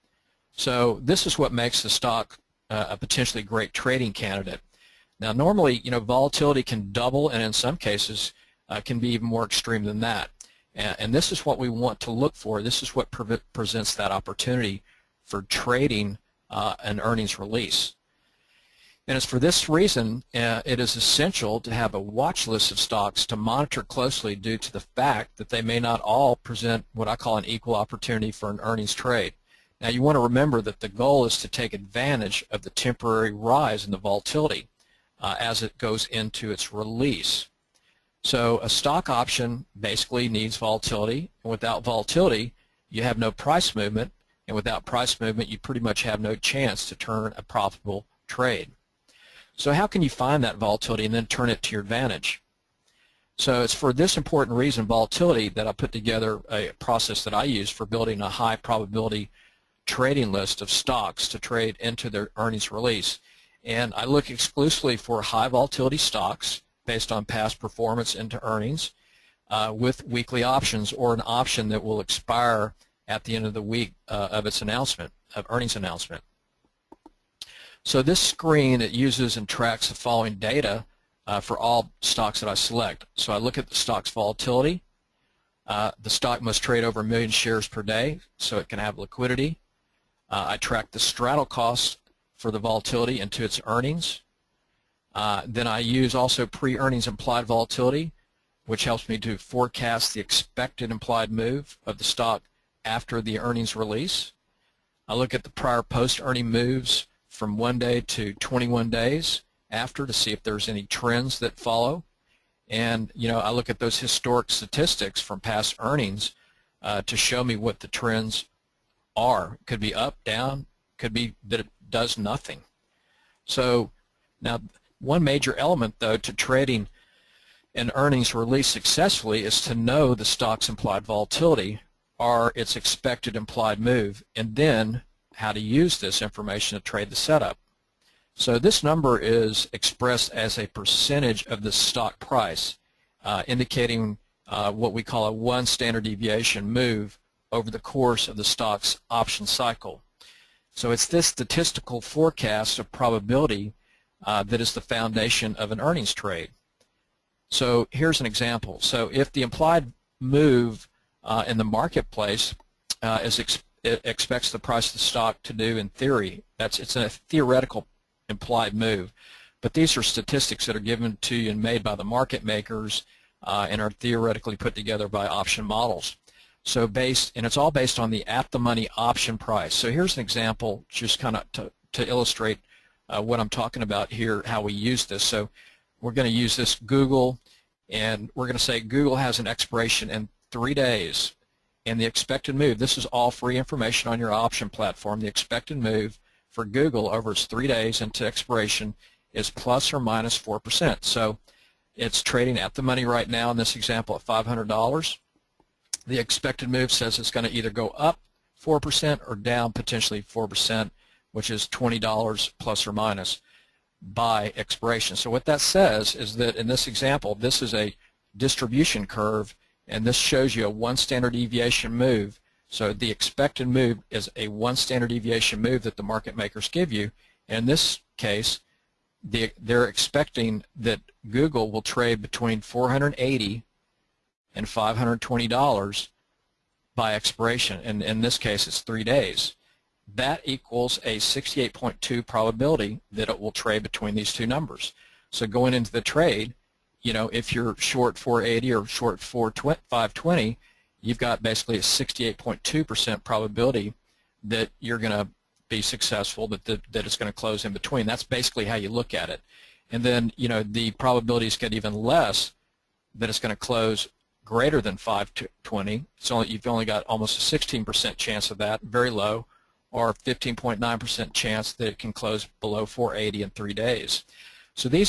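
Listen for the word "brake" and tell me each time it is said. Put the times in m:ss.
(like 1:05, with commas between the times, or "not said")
not said.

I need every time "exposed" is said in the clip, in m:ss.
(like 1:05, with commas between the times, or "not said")
not said.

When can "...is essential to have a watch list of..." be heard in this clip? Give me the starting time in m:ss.
0:20.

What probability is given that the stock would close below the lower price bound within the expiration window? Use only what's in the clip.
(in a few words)
15.9%.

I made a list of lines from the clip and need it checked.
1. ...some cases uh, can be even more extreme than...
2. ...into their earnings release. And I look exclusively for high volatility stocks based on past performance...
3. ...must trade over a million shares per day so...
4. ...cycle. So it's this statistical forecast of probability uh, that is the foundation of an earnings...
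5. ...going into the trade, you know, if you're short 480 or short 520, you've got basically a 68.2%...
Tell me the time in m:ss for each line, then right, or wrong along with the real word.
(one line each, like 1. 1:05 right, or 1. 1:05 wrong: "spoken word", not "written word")
1. 0:07 right
2. 1:01 right
3. 1:26 right
4. 2:29 right
5. 4:05 right.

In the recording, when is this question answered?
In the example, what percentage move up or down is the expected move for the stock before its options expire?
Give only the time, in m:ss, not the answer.
3:19.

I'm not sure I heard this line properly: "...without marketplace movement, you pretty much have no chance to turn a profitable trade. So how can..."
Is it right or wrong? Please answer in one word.
wrong.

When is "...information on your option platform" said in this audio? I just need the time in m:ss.
3:13.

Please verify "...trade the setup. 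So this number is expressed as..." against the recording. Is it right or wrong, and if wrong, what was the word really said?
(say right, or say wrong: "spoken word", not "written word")
right.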